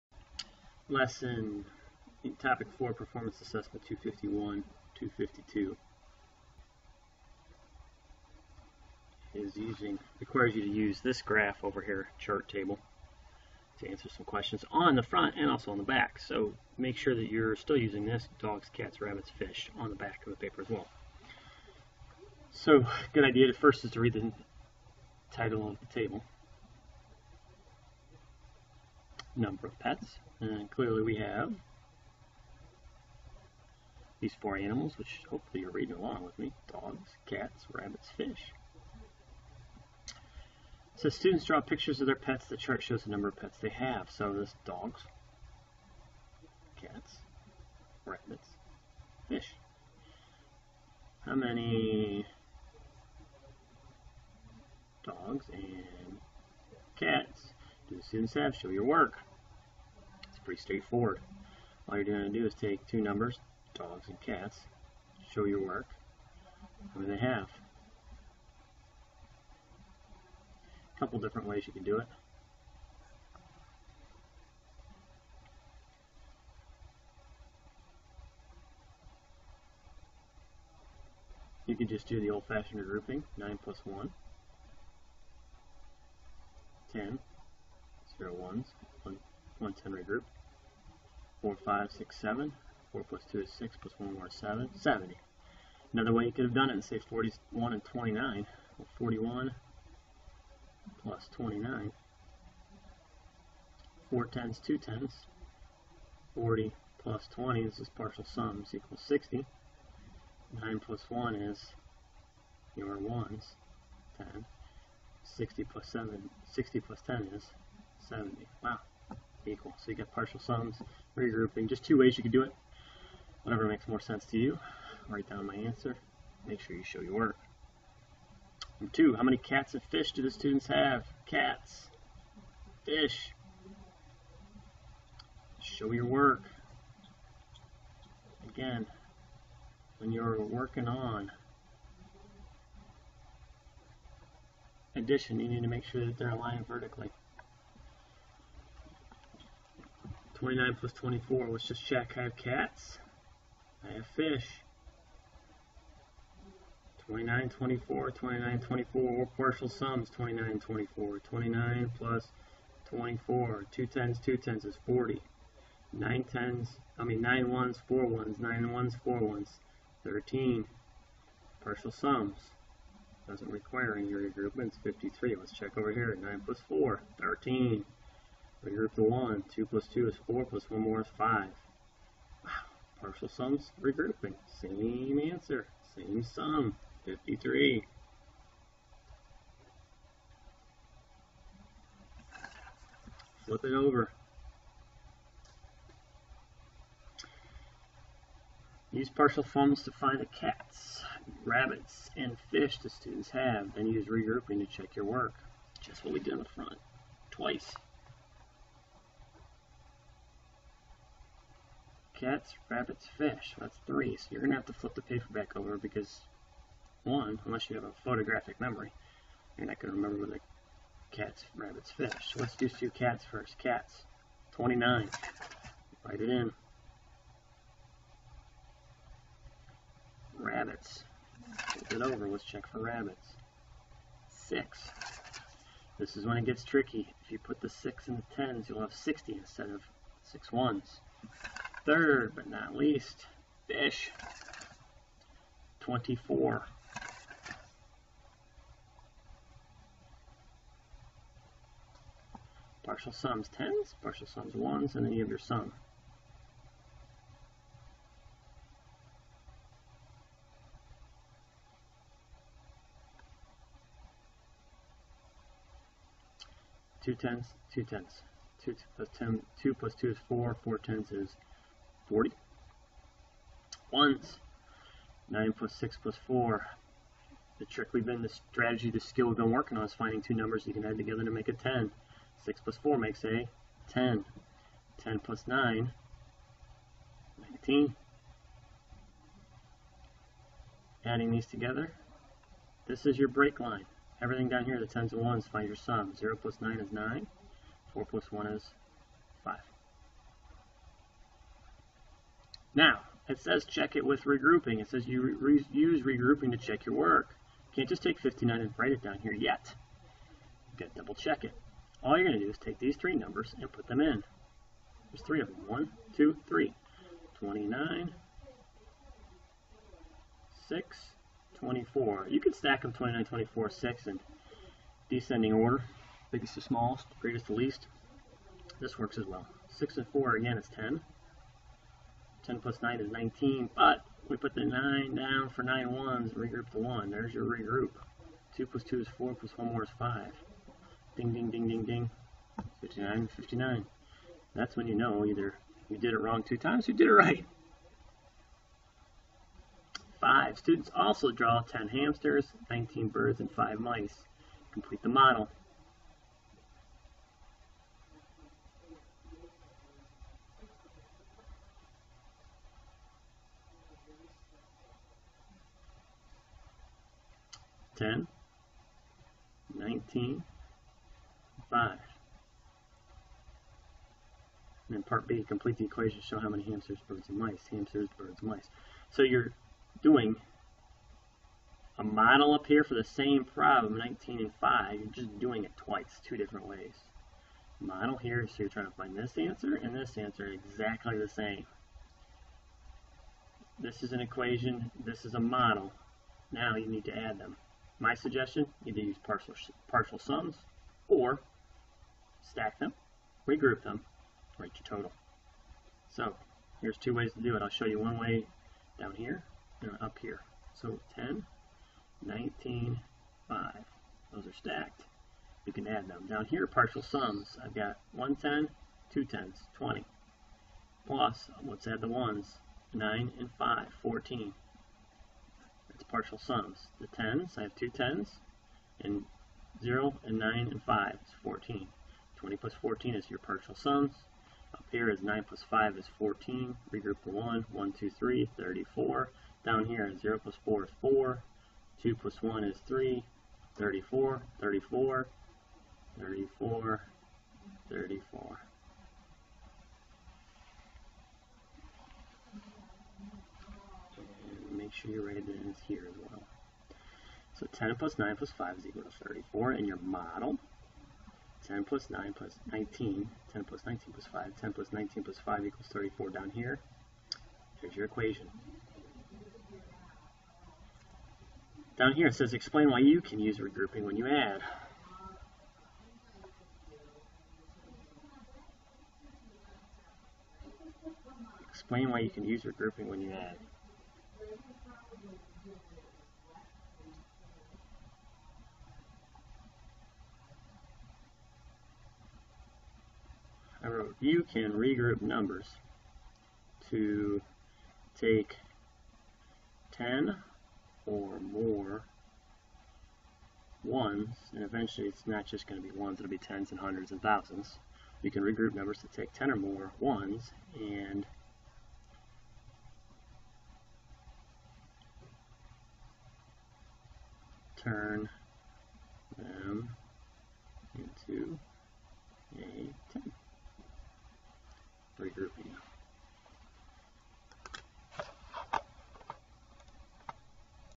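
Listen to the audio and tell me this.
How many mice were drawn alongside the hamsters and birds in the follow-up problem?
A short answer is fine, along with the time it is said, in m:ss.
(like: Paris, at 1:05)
5, at 5:53.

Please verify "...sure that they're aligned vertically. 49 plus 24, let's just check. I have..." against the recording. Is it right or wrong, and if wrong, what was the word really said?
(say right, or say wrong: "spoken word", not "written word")
wrong: "29", not "49".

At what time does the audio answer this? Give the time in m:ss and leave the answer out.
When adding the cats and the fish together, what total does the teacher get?
2:54.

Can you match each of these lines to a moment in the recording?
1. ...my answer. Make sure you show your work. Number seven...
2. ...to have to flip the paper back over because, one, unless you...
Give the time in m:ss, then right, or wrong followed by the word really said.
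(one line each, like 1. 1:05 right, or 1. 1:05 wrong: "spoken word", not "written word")
1. 2:05 wrong: "two", not "seven"
2. 3:34 right.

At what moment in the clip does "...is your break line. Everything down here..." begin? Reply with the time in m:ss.
4:53.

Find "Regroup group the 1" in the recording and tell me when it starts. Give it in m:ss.
2:58.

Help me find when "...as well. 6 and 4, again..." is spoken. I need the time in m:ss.
5:29.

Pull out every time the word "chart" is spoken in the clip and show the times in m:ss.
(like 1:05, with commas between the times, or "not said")
0:12, 0:42.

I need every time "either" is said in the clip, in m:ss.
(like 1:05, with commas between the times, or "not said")
5:45, 6:38.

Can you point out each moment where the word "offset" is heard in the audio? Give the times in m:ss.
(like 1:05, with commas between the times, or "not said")
not said.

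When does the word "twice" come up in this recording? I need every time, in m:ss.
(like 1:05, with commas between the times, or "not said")
3:27, 6:25.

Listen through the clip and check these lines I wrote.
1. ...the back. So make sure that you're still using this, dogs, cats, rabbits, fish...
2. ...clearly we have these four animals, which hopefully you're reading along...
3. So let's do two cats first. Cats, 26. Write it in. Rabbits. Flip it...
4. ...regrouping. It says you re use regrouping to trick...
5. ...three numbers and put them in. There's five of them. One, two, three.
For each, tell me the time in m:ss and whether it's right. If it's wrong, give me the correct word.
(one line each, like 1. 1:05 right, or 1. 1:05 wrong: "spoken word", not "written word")
1. 0:15 right
2. 0:30 right
3. 3:42 wrong: "29", not "26"
4. 5:04 wrong: "check", not "trick"
5. 5:12 wrong: "three", not "five".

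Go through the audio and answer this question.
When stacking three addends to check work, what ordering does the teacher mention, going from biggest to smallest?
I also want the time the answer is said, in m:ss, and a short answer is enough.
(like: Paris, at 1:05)
Descending order, at 5:25.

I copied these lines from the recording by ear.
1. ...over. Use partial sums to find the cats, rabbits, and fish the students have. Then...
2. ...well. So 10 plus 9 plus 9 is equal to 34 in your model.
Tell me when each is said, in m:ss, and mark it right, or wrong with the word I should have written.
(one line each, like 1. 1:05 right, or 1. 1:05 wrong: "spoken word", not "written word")
1. 3:13 right
2. 7:36 wrong: "5", not "9".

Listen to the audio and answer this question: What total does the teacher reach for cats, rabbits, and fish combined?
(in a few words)
59.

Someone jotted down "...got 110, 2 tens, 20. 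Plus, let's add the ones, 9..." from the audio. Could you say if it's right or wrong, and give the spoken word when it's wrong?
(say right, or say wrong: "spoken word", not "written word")
right.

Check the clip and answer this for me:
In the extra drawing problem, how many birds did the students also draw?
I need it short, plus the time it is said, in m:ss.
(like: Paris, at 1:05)
19, at 5:52.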